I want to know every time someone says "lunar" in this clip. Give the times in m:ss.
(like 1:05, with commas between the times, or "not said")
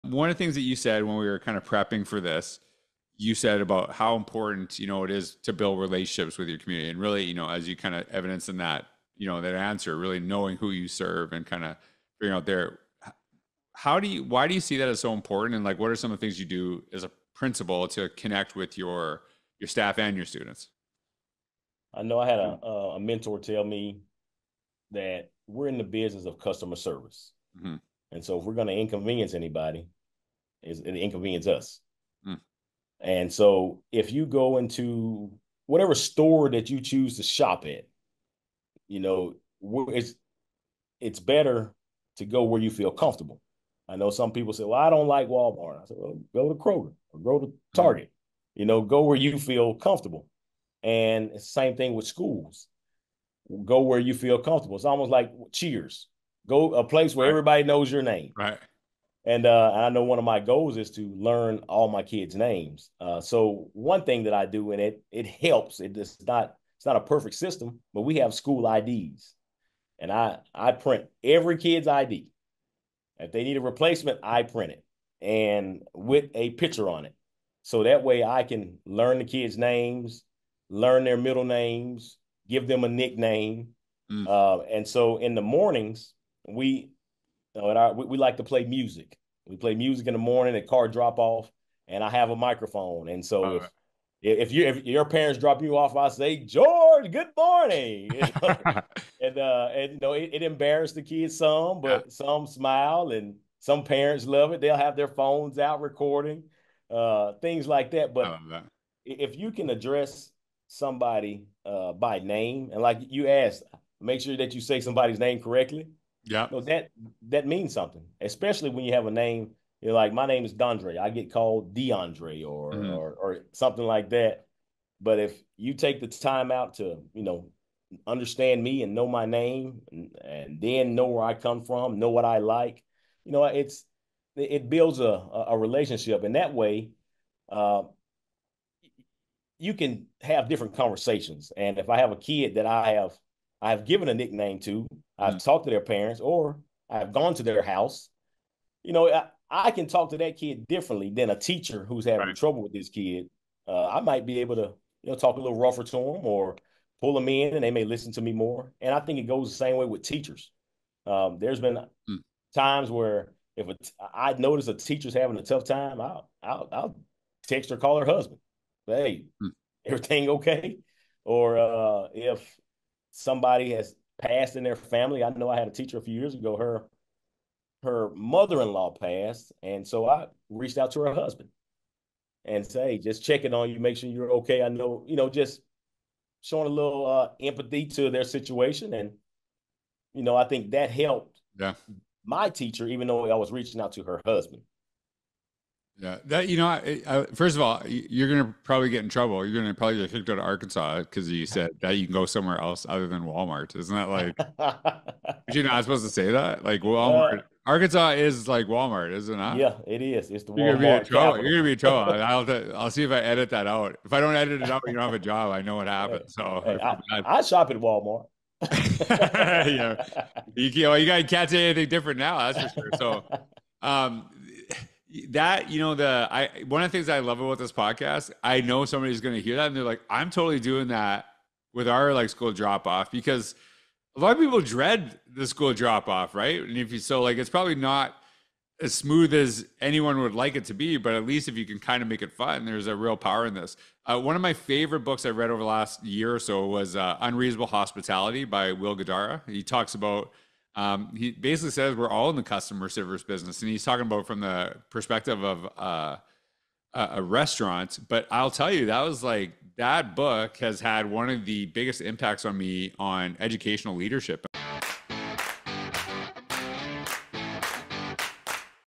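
not said.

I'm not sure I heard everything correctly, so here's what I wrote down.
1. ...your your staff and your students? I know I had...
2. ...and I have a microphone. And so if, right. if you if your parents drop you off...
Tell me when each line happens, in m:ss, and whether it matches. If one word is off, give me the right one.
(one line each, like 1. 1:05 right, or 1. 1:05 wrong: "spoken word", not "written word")
1. 0:18 right
2. 1:31 right.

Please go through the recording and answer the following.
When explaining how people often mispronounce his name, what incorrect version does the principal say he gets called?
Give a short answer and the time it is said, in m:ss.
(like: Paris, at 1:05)
DeAndre, at 2:01.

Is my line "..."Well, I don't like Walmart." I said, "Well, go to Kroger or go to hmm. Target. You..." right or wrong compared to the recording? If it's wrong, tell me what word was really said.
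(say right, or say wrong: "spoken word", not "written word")
right.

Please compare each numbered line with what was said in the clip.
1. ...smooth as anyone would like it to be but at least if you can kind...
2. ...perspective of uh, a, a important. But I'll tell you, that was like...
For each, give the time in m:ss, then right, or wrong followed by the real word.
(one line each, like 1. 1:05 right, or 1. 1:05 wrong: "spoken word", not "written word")
1. 3:58 right
2. 4:14 wrong: "restaurant", not "important".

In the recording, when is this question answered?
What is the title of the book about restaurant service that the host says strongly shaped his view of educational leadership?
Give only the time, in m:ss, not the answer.
4:07.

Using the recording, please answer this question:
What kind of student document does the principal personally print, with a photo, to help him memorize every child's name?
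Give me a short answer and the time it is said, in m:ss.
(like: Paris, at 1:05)
School IDs, at 1:08.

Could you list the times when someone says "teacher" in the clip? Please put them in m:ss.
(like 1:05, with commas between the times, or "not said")
2:31, 2:40, 2:44, 2:55, 3:12.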